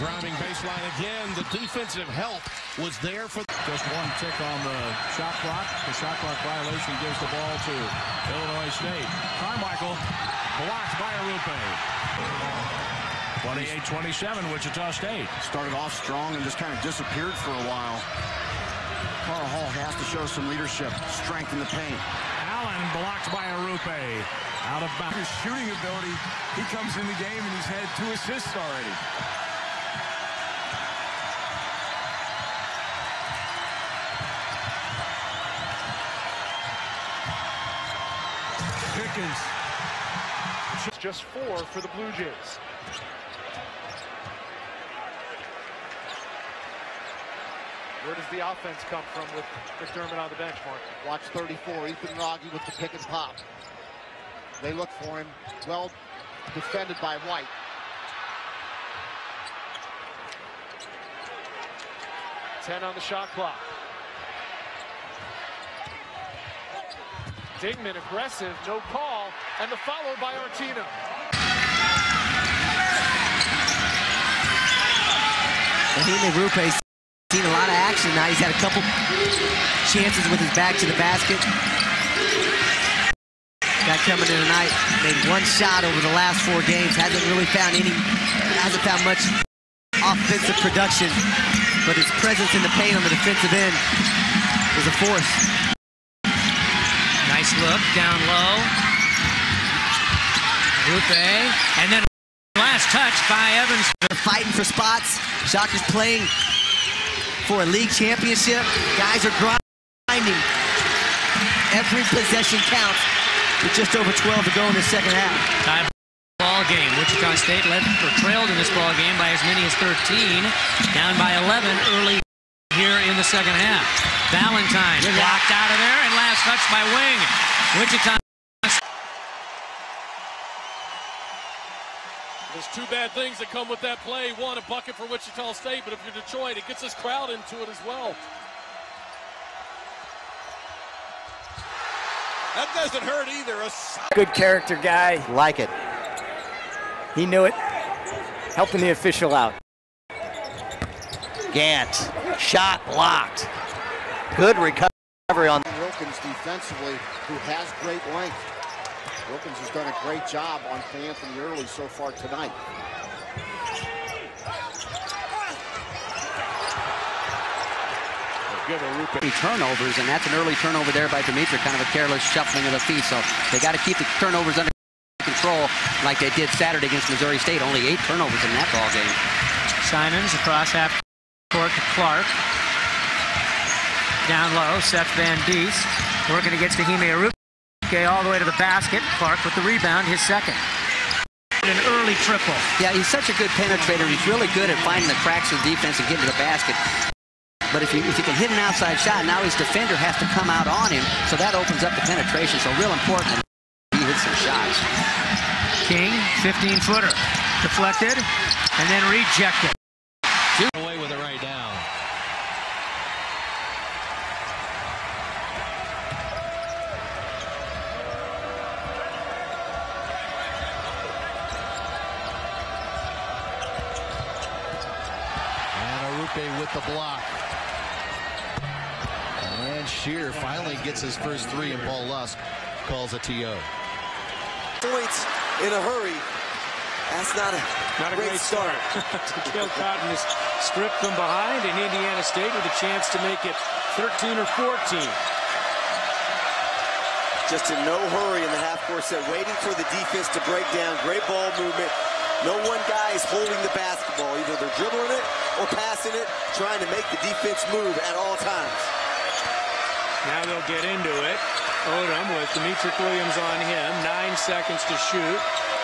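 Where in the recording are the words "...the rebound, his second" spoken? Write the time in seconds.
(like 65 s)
189 s.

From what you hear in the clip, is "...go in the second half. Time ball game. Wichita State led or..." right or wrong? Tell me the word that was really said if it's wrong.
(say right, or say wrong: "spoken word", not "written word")
right.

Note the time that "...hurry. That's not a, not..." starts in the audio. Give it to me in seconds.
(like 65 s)
235 s.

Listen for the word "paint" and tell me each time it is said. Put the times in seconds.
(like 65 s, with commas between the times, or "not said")
21 s, 92 s.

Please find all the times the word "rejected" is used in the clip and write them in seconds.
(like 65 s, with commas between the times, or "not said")
209 s.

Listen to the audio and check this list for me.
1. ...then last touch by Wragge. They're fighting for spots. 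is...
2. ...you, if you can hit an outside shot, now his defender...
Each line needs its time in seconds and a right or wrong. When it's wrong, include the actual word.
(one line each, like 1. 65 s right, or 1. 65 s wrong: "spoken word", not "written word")
1. 101 s wrong: "Evans", not "Wragge"
2. 197 s right.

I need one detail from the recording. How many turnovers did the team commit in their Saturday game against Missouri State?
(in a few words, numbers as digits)
8.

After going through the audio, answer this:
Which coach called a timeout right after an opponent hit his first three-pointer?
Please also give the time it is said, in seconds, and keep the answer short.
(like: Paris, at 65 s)
Paul Lusk, at 231 s.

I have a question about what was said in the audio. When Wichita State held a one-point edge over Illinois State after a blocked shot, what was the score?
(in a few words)
28-27.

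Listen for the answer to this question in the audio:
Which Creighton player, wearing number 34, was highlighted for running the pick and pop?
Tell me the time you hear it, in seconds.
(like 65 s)
51 s.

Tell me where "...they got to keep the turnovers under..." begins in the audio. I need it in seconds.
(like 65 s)
173 s.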